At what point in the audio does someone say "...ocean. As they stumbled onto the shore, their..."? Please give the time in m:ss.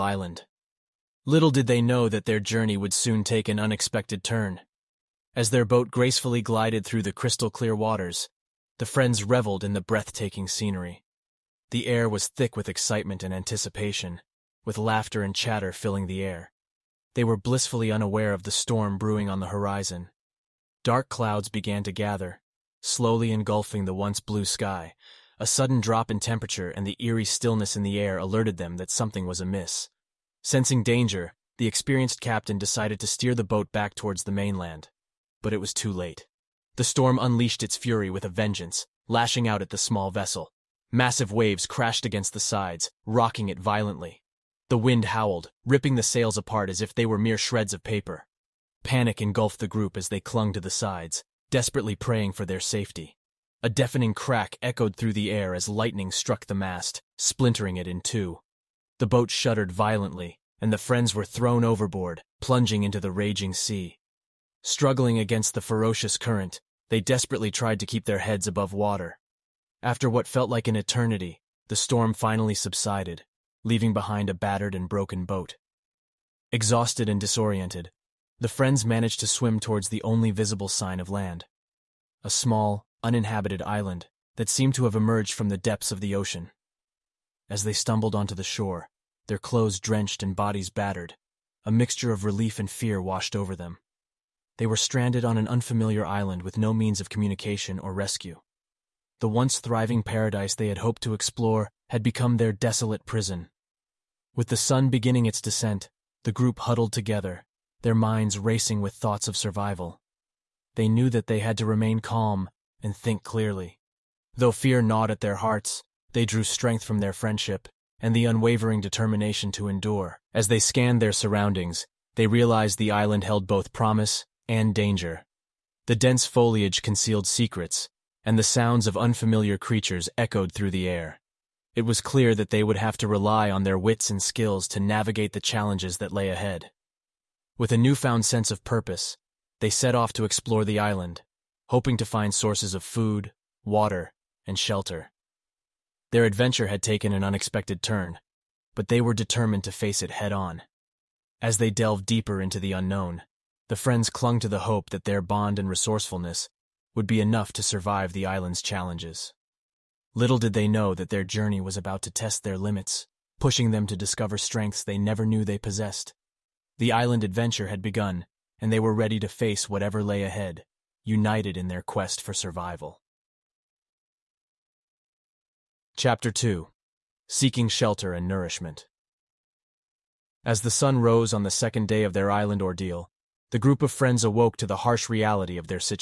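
1:26.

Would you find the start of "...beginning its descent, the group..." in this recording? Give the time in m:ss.
1:44.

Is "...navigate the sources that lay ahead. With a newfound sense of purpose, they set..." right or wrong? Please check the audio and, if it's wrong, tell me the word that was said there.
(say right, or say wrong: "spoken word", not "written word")
wrong: "challenges", not "sources".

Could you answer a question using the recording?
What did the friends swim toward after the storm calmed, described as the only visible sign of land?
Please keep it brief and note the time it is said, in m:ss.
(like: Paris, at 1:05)
A small uninhabited island, at 1:23.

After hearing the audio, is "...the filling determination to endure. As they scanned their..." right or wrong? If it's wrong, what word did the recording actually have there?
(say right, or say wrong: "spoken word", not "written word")
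wrong: "unwavering", not "filling".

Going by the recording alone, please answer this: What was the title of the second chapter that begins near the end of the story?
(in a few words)
Seeking Shelter and Nourishment.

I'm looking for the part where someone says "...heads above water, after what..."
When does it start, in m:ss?
1:08.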